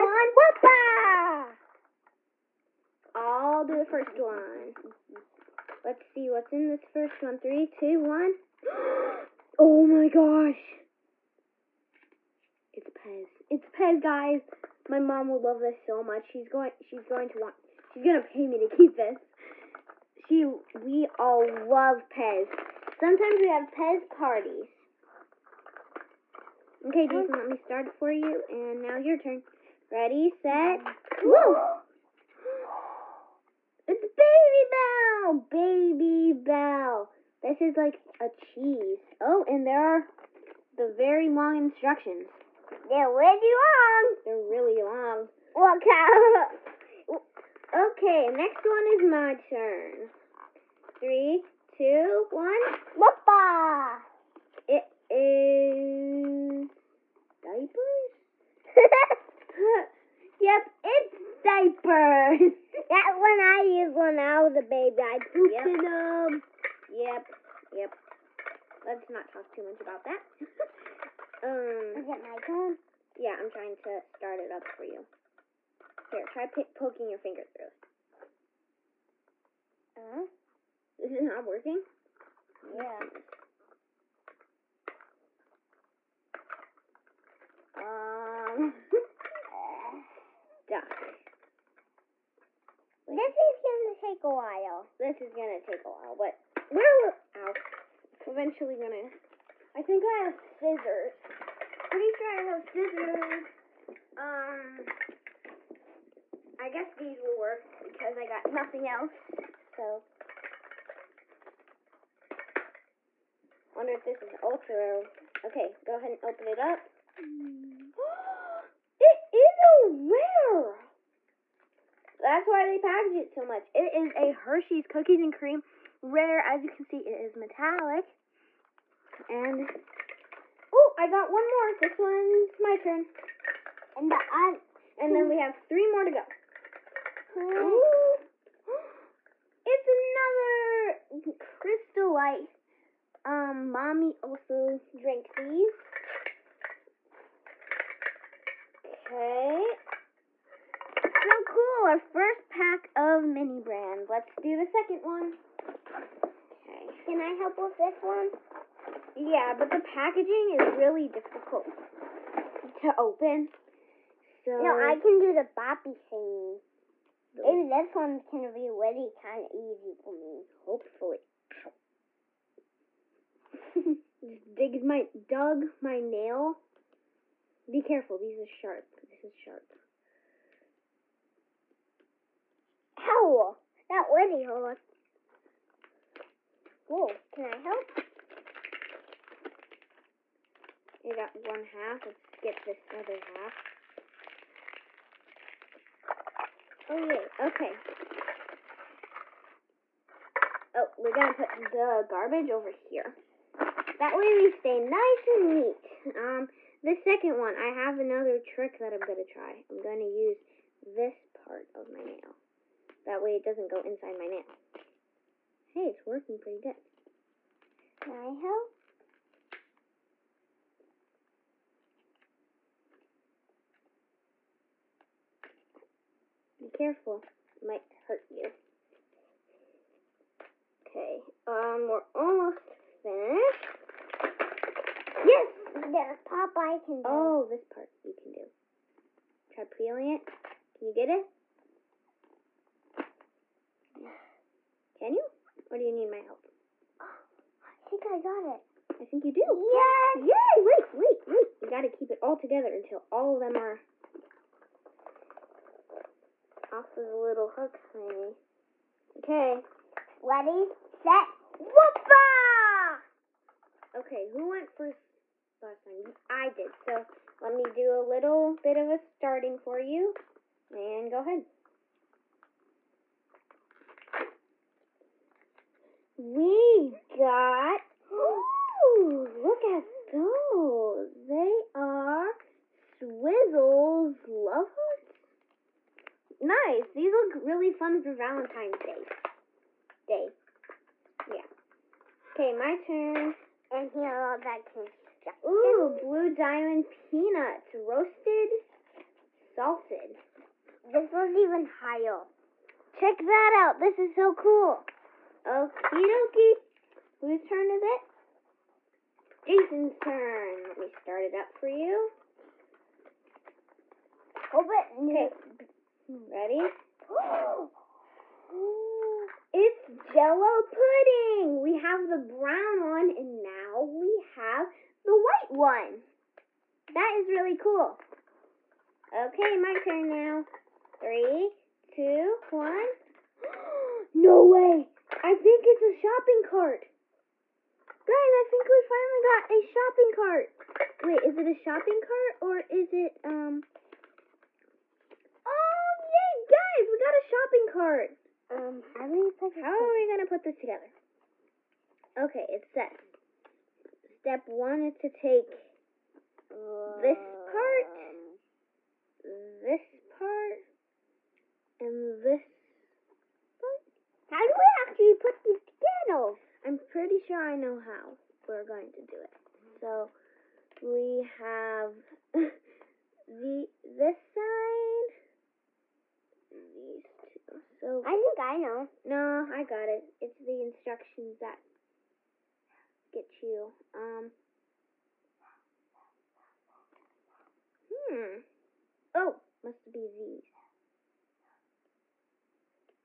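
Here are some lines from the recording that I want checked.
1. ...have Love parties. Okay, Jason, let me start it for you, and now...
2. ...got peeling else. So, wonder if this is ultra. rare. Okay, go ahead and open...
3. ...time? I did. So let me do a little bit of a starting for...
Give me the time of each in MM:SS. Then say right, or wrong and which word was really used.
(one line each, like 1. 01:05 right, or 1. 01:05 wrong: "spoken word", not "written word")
1. 00:23 wrong: "Pez", not "Love"
2. 01:48 wrong: "nothing", not "peeling"
3. 04:25 right.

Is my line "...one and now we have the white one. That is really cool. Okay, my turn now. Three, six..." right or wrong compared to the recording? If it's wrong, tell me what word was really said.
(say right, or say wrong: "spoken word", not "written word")
wrong: "two", not "six".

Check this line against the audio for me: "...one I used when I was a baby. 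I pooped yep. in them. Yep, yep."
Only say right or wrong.
right.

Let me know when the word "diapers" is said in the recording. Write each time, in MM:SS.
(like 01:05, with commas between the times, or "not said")
00:57, 01:01.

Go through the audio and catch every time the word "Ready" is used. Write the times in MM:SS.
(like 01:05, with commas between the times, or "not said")
00:29, 04:20, 05:16.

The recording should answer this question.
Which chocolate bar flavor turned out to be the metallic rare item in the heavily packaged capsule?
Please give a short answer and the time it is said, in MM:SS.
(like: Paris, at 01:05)
Hershey's Cookies and Cream, at 02:04.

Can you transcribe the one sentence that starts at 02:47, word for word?
Maybe this one can be really kind of easy for me.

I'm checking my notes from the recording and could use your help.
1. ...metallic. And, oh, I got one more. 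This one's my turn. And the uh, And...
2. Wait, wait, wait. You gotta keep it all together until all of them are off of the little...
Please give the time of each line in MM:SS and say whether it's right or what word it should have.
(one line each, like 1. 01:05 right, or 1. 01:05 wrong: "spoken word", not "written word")
1. 02:07 right
2. 04:10 right.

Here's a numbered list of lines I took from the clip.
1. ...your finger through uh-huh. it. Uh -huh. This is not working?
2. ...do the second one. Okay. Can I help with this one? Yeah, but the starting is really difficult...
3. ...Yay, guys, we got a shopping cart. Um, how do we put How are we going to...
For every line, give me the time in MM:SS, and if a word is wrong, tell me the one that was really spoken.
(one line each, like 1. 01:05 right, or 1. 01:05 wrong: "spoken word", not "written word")
1. 01:17 right
2. 02:34 wrong: "packaging", not "starting"
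3. 05:46 right.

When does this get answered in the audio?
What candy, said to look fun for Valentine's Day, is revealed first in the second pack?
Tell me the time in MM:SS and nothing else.
04:42.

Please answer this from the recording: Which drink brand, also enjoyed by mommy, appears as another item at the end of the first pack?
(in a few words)
Crystal Light.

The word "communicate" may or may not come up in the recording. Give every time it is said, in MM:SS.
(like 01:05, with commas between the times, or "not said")
not said.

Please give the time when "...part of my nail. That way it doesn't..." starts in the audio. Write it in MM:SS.
03:31.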